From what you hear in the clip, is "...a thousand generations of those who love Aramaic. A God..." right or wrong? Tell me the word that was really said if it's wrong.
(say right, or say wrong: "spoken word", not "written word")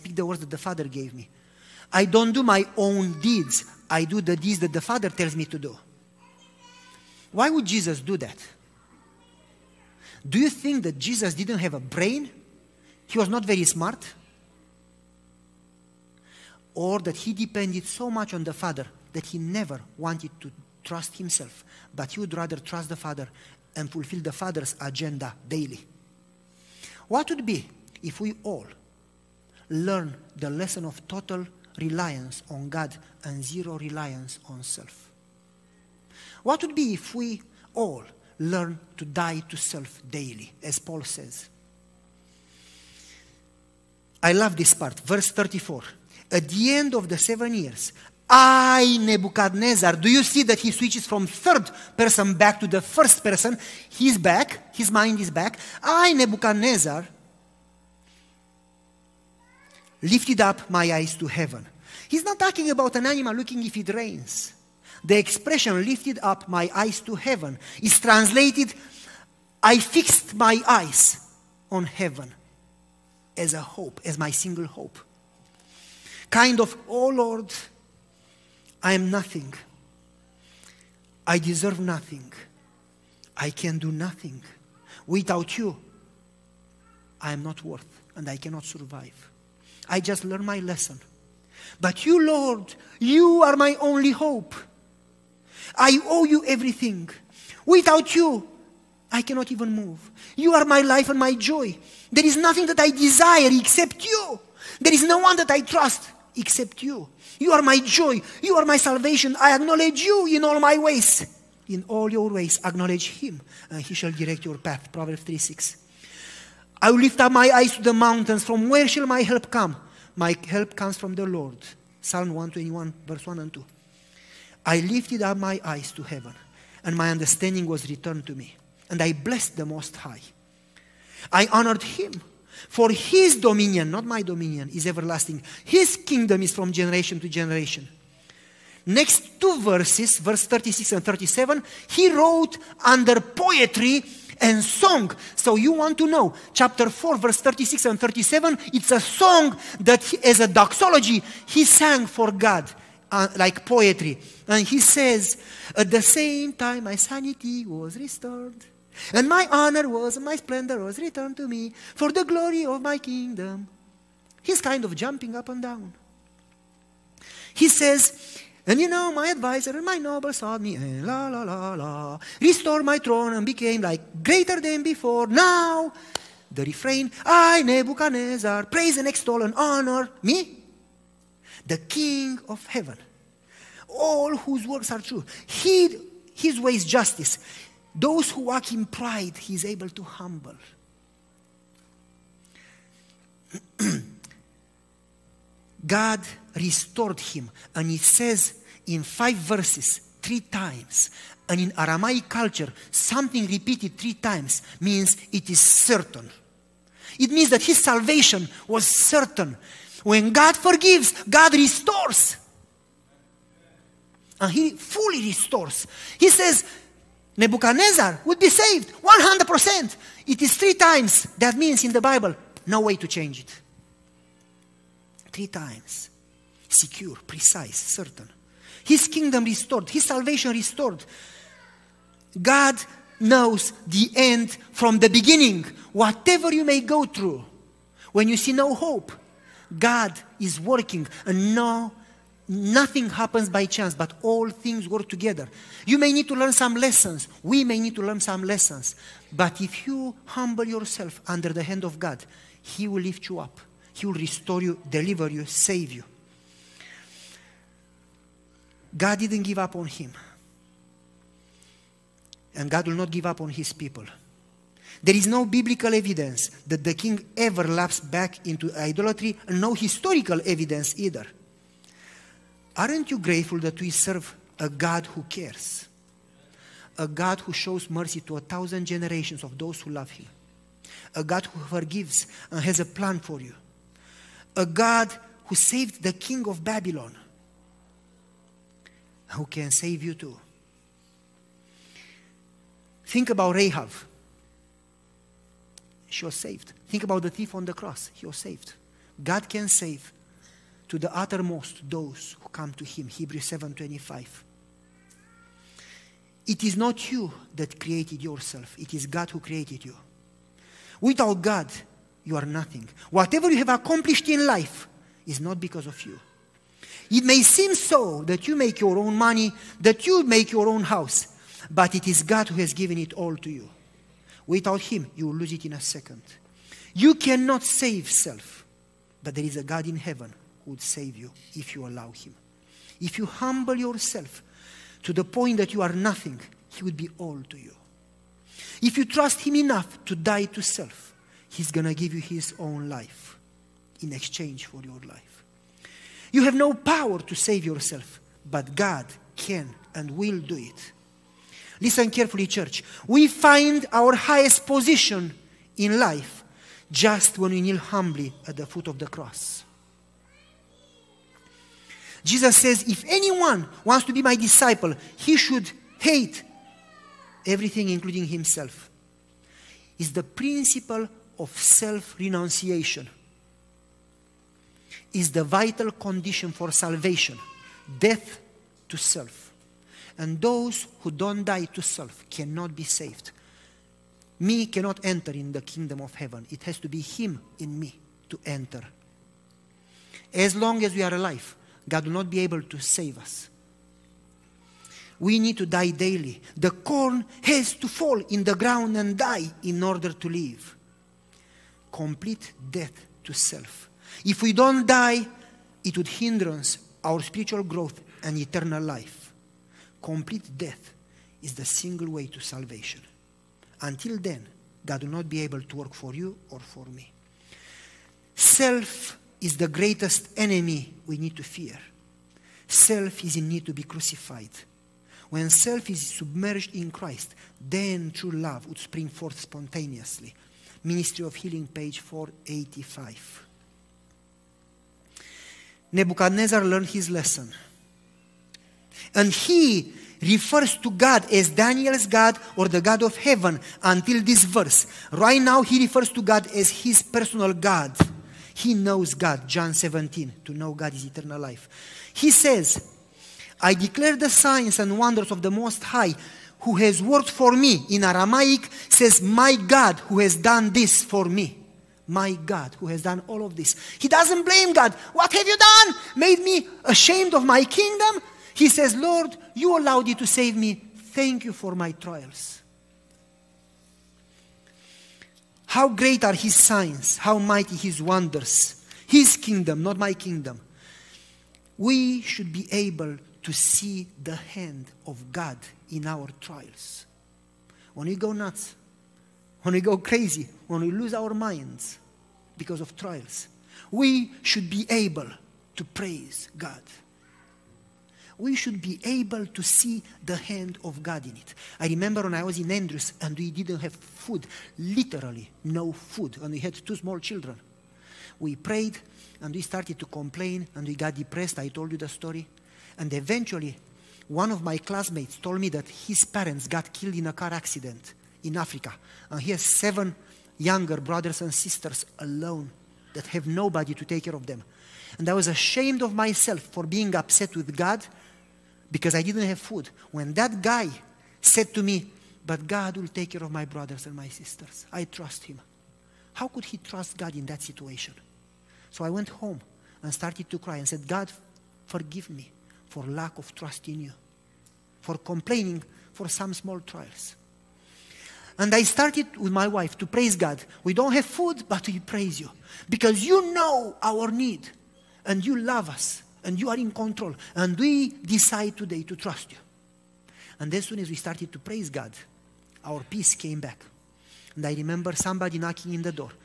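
wrong: "Him", not "Aramaic".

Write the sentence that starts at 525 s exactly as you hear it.
And I was ashamed of myself for being upset with God because I didn't have food.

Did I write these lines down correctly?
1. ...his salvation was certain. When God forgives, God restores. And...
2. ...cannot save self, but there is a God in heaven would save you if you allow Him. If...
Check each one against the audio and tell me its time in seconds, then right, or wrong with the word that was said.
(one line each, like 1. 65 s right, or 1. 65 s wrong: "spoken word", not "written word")
1. 207 s right
2. 327 s right.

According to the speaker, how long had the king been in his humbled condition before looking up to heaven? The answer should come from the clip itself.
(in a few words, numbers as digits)
7 years.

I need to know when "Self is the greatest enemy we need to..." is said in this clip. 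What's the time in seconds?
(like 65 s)
418 s.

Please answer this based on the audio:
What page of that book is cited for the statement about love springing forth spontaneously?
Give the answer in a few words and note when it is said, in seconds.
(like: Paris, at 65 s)
485, at 431 s.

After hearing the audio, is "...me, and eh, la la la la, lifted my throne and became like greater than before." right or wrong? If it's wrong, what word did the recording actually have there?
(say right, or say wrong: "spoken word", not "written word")
wrong: "restored", not "lifted".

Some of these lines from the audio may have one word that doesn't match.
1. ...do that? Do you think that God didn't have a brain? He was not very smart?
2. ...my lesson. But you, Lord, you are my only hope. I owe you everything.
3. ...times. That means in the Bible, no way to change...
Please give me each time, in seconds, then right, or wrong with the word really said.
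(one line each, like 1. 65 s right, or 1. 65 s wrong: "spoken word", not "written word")
1. 8 s wrong: "Jesus", not "God"
2. 90 s right
3. 220 s right.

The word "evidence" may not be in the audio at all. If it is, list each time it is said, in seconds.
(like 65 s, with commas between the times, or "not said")
265 s, 270 s.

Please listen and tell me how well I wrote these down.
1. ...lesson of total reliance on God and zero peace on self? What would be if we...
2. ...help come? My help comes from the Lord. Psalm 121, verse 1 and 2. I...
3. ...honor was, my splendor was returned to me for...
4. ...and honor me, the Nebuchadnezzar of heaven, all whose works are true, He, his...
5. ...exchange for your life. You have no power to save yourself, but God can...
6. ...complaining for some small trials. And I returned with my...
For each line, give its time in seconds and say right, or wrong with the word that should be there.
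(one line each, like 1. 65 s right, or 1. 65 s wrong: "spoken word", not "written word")
1. 30 s wrong: "reliance", not "peace"
2. 119 s right
3. 159 s right
4. 179 s wrong: "King", not "Nebuchadnezzar"
5. 344 s right
6. 545 s wrong: "started", not "returned".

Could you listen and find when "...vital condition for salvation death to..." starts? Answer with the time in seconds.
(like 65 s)
375 s.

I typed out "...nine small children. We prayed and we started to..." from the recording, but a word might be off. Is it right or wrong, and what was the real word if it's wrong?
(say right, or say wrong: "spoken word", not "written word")
wrong: "two", not "nine".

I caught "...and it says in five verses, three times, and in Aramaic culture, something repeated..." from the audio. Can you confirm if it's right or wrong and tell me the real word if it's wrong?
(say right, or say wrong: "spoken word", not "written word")
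right.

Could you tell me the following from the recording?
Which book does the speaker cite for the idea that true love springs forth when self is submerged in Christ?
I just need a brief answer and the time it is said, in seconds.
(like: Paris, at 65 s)
Ministry of Healing, at 430 s.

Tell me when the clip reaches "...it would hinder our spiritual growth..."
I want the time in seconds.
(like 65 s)
405 s.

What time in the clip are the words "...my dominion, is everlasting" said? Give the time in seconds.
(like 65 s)
134 s.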